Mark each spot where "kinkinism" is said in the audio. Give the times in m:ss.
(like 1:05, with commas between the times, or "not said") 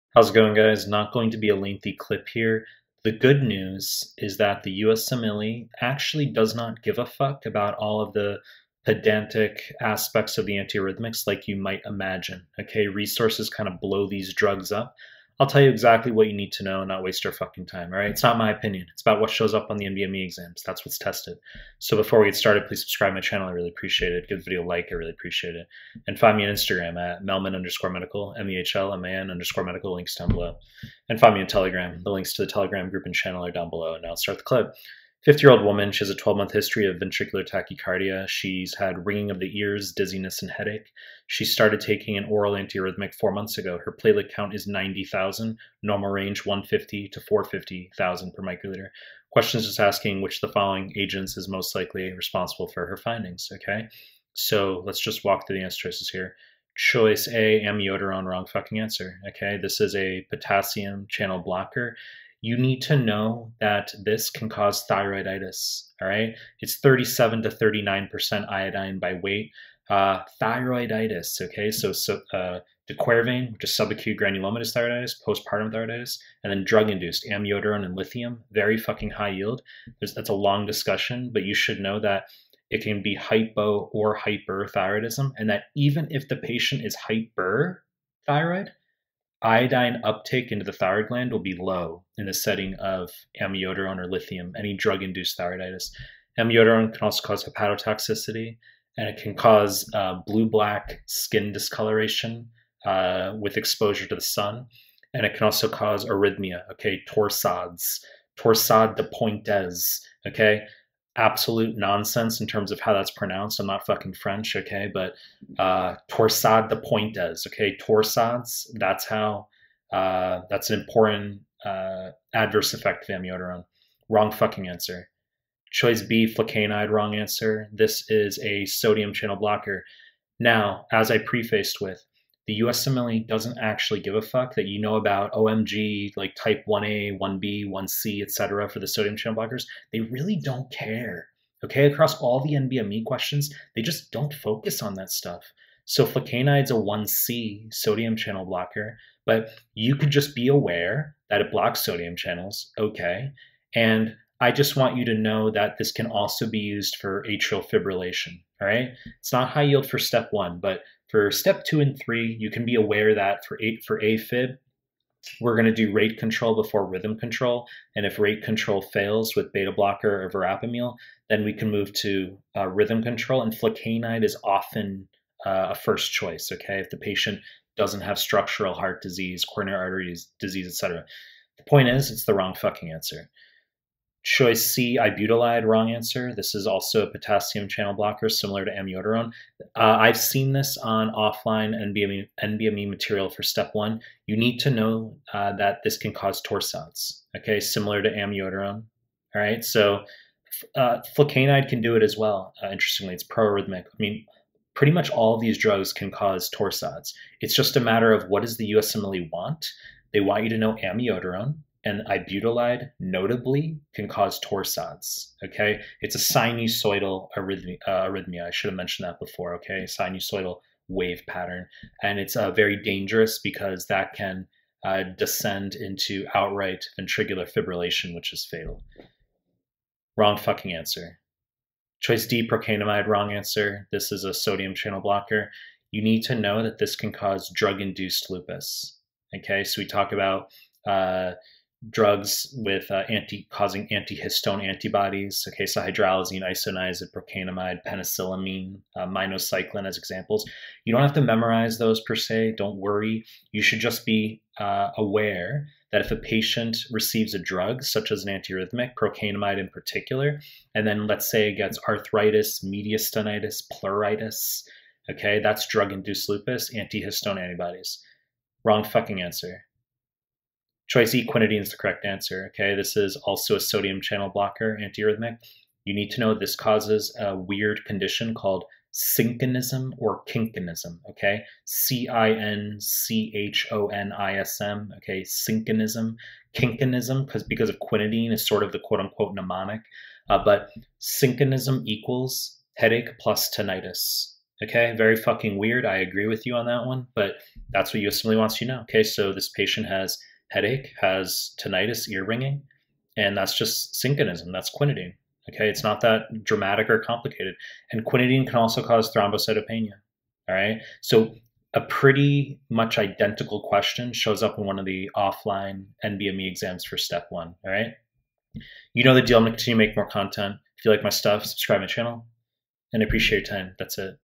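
4:40, 4:46.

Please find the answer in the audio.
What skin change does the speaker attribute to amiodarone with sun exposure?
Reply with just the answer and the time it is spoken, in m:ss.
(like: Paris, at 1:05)
blue black skin discoloration, at 1:40.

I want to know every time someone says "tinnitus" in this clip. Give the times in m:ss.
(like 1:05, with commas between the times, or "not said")
4:53, 5:01.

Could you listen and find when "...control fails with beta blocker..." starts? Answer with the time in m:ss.
2:48.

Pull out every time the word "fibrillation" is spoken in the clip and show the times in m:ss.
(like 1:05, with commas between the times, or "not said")
2:37, 3:47.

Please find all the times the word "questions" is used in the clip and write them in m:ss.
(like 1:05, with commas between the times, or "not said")
0:49, 2:23, 5:13.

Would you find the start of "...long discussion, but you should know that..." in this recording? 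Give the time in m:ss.
1:20.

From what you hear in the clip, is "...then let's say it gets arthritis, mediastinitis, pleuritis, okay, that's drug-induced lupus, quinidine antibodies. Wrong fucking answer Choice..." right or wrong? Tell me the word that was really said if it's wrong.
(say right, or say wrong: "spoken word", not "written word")
wrong: "antihistone", not "quinidine".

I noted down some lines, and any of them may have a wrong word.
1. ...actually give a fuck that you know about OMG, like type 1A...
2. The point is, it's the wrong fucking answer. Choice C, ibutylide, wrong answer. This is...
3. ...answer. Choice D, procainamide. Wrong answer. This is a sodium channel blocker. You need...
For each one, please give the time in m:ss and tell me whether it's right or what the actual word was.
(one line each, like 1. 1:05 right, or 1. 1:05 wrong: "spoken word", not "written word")
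1. 2:13 right
2. 3:01 right
3. 3:50 right.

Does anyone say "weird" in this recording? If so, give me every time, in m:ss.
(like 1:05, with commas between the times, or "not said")
4:37, 4:55.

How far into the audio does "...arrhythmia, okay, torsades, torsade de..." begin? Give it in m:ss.
1:46.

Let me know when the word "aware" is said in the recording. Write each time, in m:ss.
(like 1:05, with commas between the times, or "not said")
2:30, 2:42, 4:14.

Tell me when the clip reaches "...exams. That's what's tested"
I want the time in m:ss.
0:20.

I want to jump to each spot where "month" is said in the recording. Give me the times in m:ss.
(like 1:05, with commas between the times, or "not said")
0:36, 0:43.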